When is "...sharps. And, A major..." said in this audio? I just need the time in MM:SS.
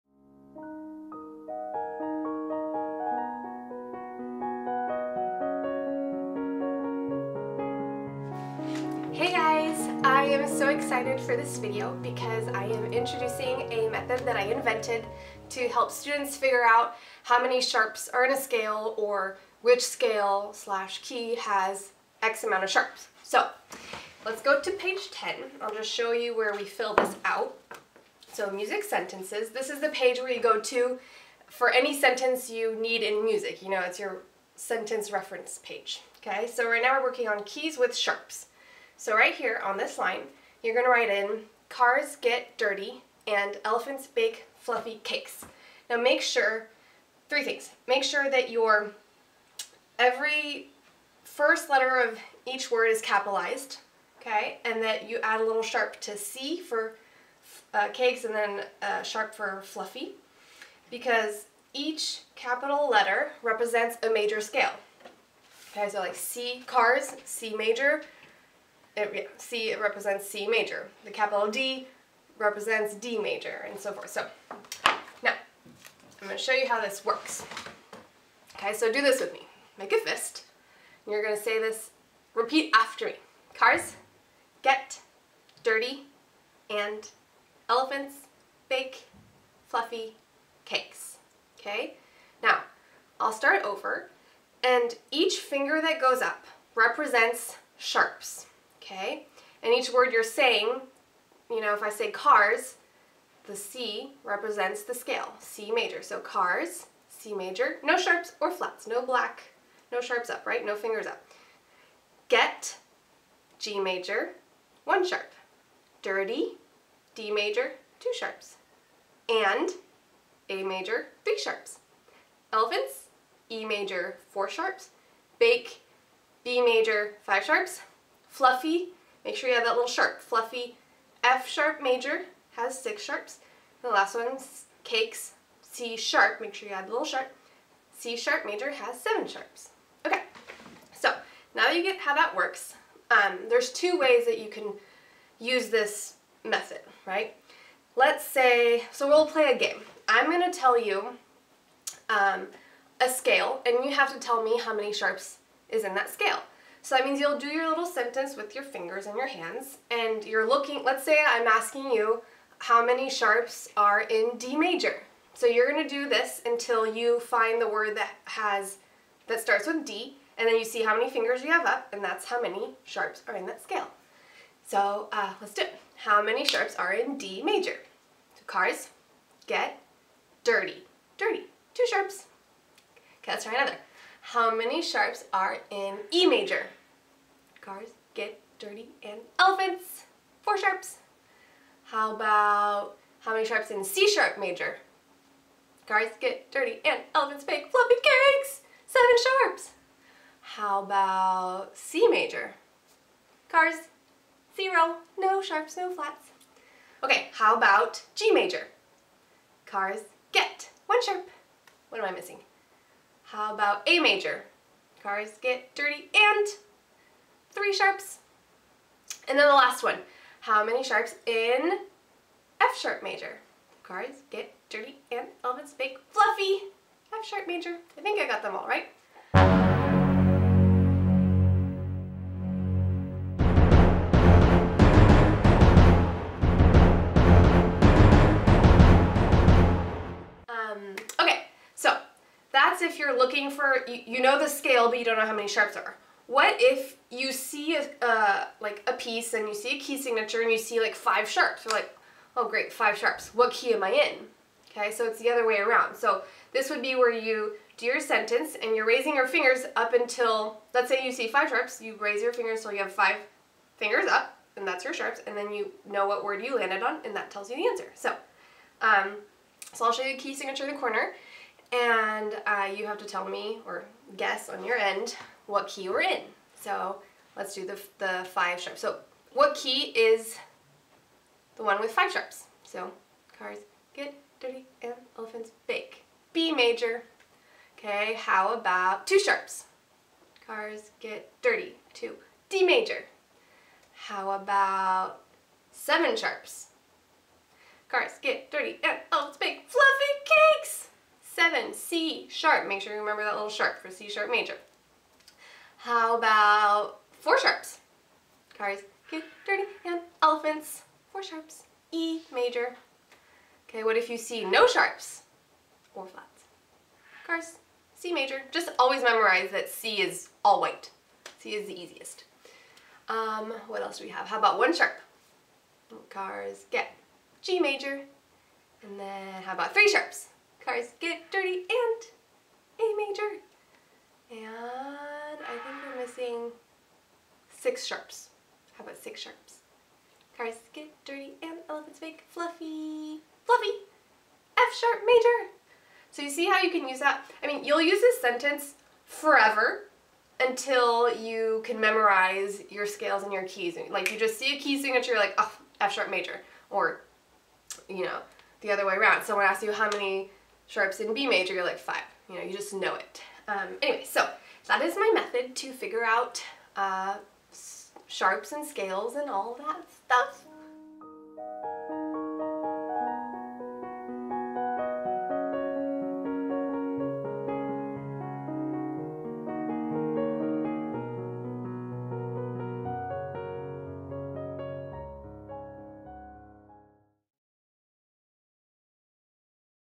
01:58.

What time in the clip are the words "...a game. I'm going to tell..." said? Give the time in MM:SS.
02:29.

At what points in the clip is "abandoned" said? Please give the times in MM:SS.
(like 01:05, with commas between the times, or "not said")
not said.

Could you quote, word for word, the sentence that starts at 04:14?
Okay, so it's the other way around.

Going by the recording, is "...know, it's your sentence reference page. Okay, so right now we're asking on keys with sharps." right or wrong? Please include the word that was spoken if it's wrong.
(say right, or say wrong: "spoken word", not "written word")
wrong: "working", not "asking".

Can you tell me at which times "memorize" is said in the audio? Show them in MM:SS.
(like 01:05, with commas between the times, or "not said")
05:19, 05:51.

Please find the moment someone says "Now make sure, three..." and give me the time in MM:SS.
00:45.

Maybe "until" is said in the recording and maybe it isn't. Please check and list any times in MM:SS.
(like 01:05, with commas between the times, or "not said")
02:46, 04:19, 05:50.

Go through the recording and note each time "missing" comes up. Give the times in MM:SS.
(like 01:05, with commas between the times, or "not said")
03:32, 05:36.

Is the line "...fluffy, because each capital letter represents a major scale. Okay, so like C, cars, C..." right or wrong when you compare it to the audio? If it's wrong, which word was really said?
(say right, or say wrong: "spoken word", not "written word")
right.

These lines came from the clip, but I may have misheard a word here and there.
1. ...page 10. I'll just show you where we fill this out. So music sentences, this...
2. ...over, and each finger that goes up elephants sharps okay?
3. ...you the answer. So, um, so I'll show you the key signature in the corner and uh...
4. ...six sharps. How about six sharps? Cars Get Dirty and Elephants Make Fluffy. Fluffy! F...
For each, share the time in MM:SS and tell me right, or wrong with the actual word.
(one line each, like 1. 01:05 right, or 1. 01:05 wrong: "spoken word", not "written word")
1. 00:24 right
2. 01:33 wrong: "represents", not "elephants"
3. 04:27 right
4. 05:37 right.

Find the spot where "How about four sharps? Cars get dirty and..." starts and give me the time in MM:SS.
05:05.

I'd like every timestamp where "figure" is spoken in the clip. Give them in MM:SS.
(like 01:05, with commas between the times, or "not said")
00:16, 06:05.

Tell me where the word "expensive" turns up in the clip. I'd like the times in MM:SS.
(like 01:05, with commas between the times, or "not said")
not said.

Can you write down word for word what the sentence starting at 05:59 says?
Someone asks you how many sharps in B major, you're like five.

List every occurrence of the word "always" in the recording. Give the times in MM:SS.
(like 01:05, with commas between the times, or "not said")
05:18.